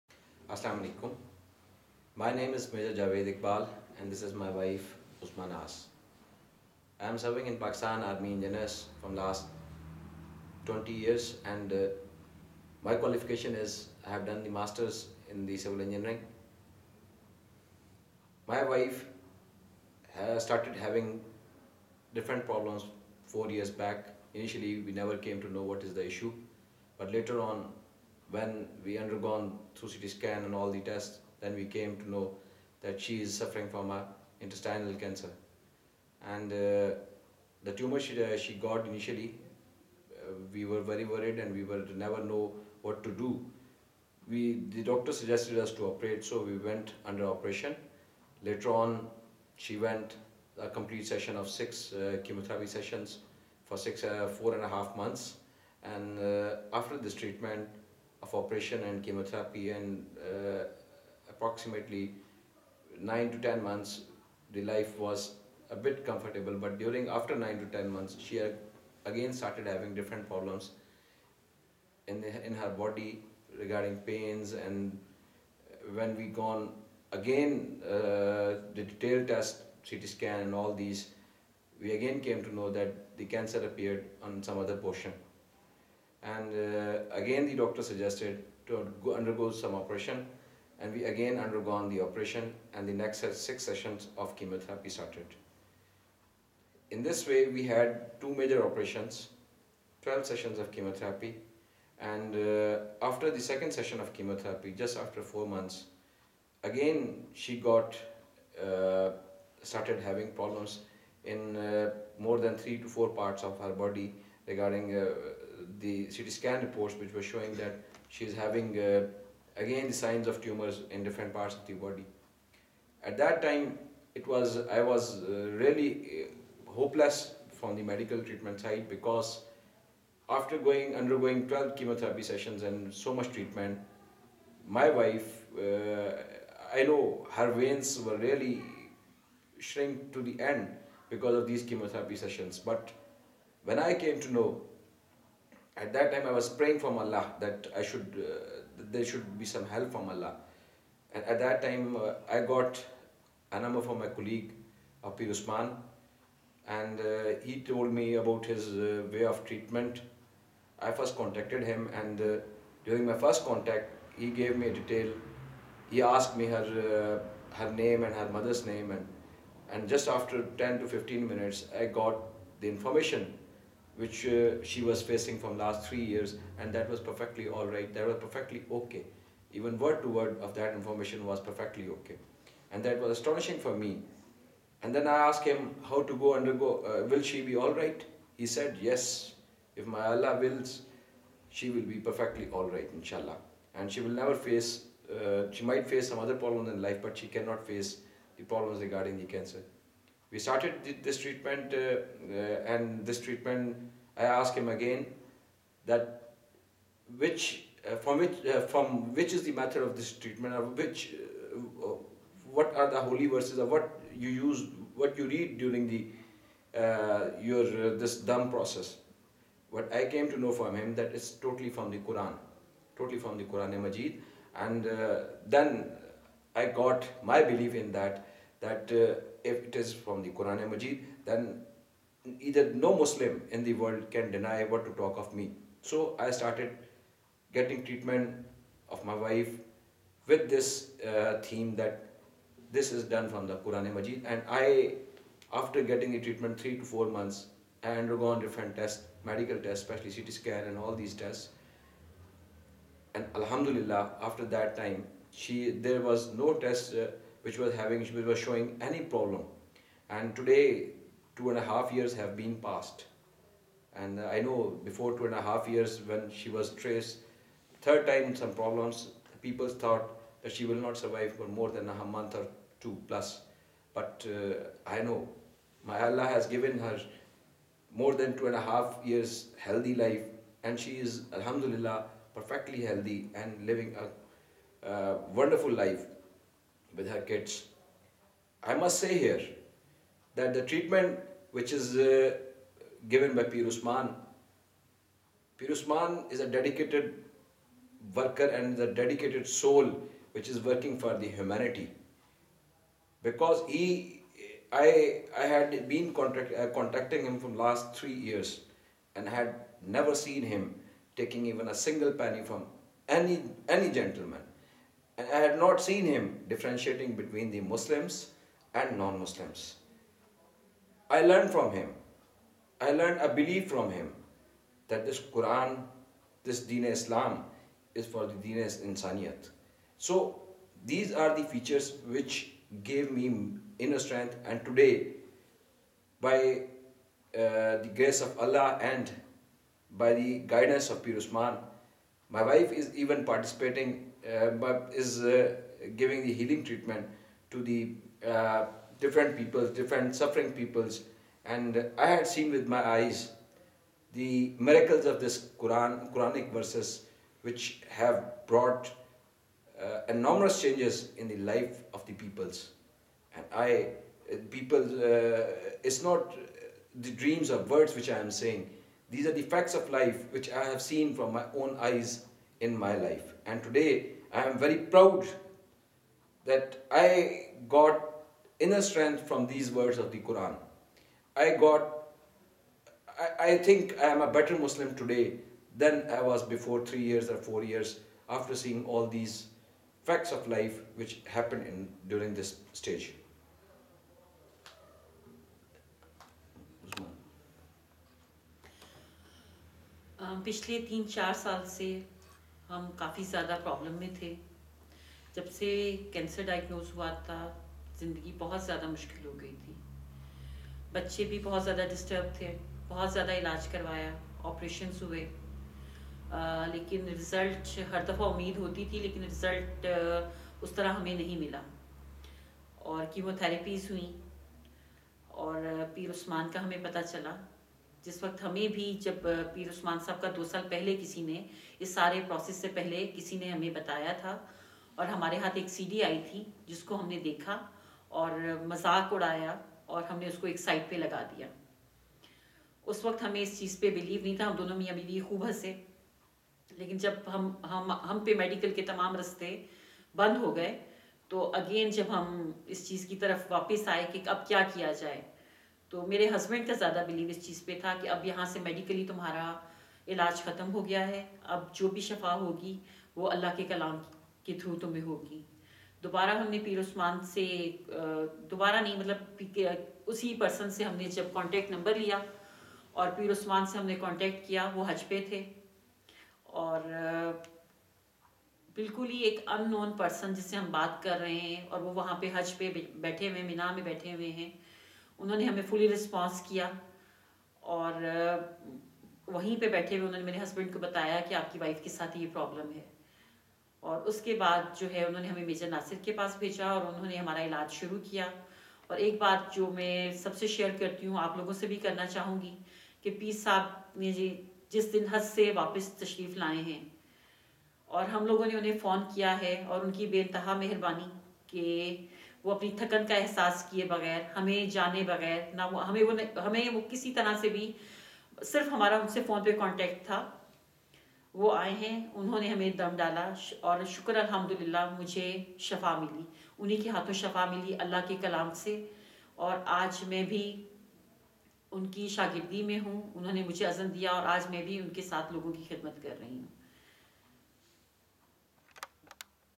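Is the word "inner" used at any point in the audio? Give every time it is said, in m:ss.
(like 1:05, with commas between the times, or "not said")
5:33, 6:18.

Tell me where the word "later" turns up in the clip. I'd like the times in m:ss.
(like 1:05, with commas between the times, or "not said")
0:27, 0:48.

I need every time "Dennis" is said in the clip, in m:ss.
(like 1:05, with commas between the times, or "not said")
not said.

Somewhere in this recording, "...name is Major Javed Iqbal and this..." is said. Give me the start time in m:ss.
0:02.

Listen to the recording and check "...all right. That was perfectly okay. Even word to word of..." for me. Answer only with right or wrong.
right.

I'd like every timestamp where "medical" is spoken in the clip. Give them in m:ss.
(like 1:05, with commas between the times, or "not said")
2:07, 4:09.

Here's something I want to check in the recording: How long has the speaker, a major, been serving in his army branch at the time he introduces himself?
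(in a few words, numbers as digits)
20 years.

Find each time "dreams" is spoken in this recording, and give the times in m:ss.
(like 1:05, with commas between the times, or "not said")
6:07.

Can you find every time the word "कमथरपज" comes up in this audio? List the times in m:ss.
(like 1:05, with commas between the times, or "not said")
7:03.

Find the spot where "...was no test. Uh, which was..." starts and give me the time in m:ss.
4:16.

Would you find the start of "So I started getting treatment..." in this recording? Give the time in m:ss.
3:55.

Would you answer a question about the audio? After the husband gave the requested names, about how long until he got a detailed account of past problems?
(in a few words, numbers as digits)
10 to 15 minutes.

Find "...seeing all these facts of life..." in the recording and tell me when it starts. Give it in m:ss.
6:28.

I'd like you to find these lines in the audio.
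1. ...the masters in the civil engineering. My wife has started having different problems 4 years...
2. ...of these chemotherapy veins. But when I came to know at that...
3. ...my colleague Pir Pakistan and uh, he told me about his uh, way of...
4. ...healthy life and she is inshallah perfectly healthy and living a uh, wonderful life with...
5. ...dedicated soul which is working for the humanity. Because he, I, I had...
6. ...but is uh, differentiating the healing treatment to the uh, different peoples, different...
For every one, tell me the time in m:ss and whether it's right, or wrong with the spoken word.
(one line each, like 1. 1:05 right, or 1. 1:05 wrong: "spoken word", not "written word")
1. 0:14 right
2. 2:21 wrong: "sessions", not "veins"
3. 2:33 wrong: "Usman", not "Pakistan"
4. 4:39 wrong: "alhamdulillah", not "inshallah"
5. 4:58 right
6. 5:44 wrong: "giving", not "differentiating".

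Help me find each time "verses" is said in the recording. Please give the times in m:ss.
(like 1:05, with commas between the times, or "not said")
3:33, 5:56.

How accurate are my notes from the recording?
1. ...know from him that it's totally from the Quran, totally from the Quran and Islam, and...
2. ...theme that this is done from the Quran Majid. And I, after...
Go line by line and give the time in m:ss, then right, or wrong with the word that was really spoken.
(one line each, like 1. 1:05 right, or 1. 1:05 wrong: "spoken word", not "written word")
1. 3:40 wrong: "Majid", not "Islam"
2. 4:01 right.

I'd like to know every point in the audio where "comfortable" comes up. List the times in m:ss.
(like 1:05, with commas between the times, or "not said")
1:06.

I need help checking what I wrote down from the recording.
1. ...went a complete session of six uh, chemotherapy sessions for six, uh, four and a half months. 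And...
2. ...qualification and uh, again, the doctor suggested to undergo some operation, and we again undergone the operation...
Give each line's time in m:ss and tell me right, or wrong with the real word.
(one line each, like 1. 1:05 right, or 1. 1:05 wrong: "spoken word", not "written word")
1. 0:49 right
2. 1:24 wrong: "portion", not "qualification".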